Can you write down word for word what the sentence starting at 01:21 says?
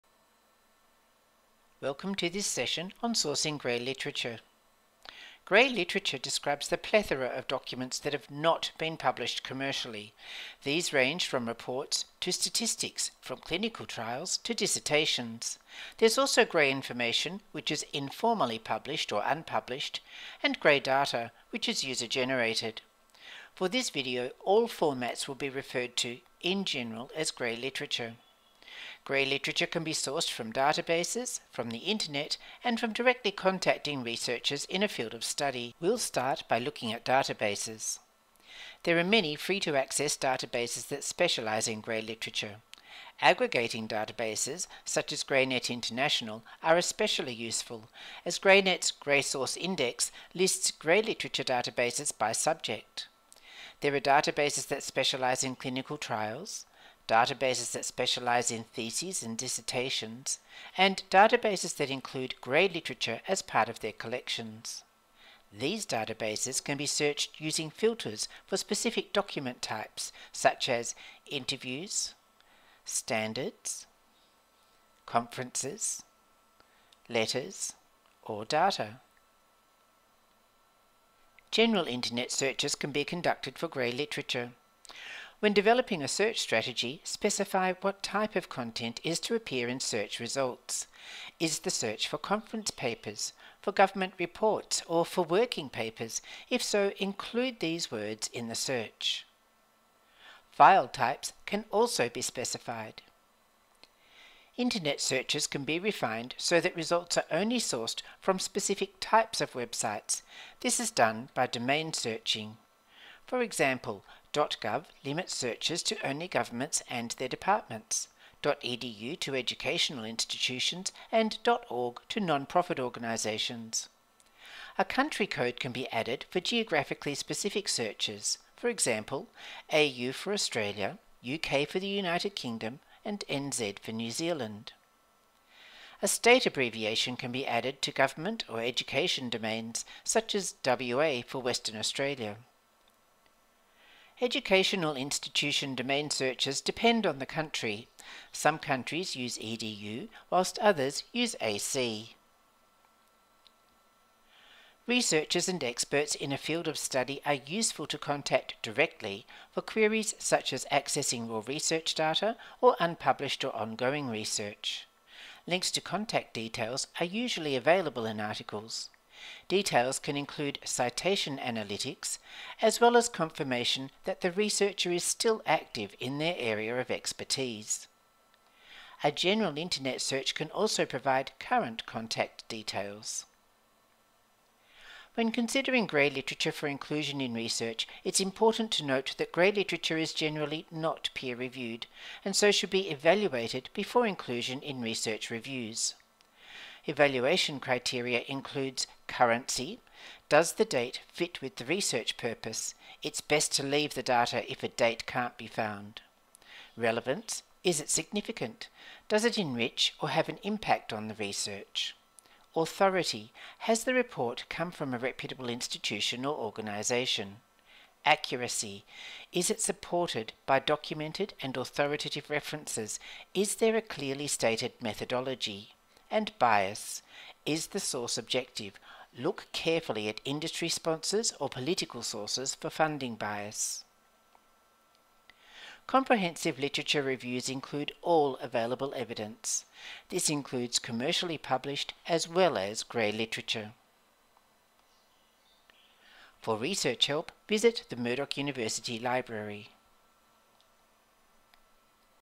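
General internet searches can be conducted for grey literature.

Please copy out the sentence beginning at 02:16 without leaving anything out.
A state abbreviation can be added to government or education domains, such as WA for Western Australia.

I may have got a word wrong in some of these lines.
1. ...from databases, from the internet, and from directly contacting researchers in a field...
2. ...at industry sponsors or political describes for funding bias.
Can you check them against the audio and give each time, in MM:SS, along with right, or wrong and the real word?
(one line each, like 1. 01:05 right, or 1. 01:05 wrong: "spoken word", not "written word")
1. 00:30 right
2. 03:50 wrong: "sources", not "describes".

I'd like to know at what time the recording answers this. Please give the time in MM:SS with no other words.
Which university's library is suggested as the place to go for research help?
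04:07.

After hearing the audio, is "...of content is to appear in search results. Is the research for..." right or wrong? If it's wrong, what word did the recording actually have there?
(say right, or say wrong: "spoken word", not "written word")
wrong: "search", not "research".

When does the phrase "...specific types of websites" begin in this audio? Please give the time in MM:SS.
01:48.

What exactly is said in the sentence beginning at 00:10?
These range from reports to statistics, from clinical trials to dissertations.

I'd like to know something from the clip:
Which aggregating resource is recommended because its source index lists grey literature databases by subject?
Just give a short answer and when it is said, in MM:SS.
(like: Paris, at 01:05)
GreyNet International, at 00:45.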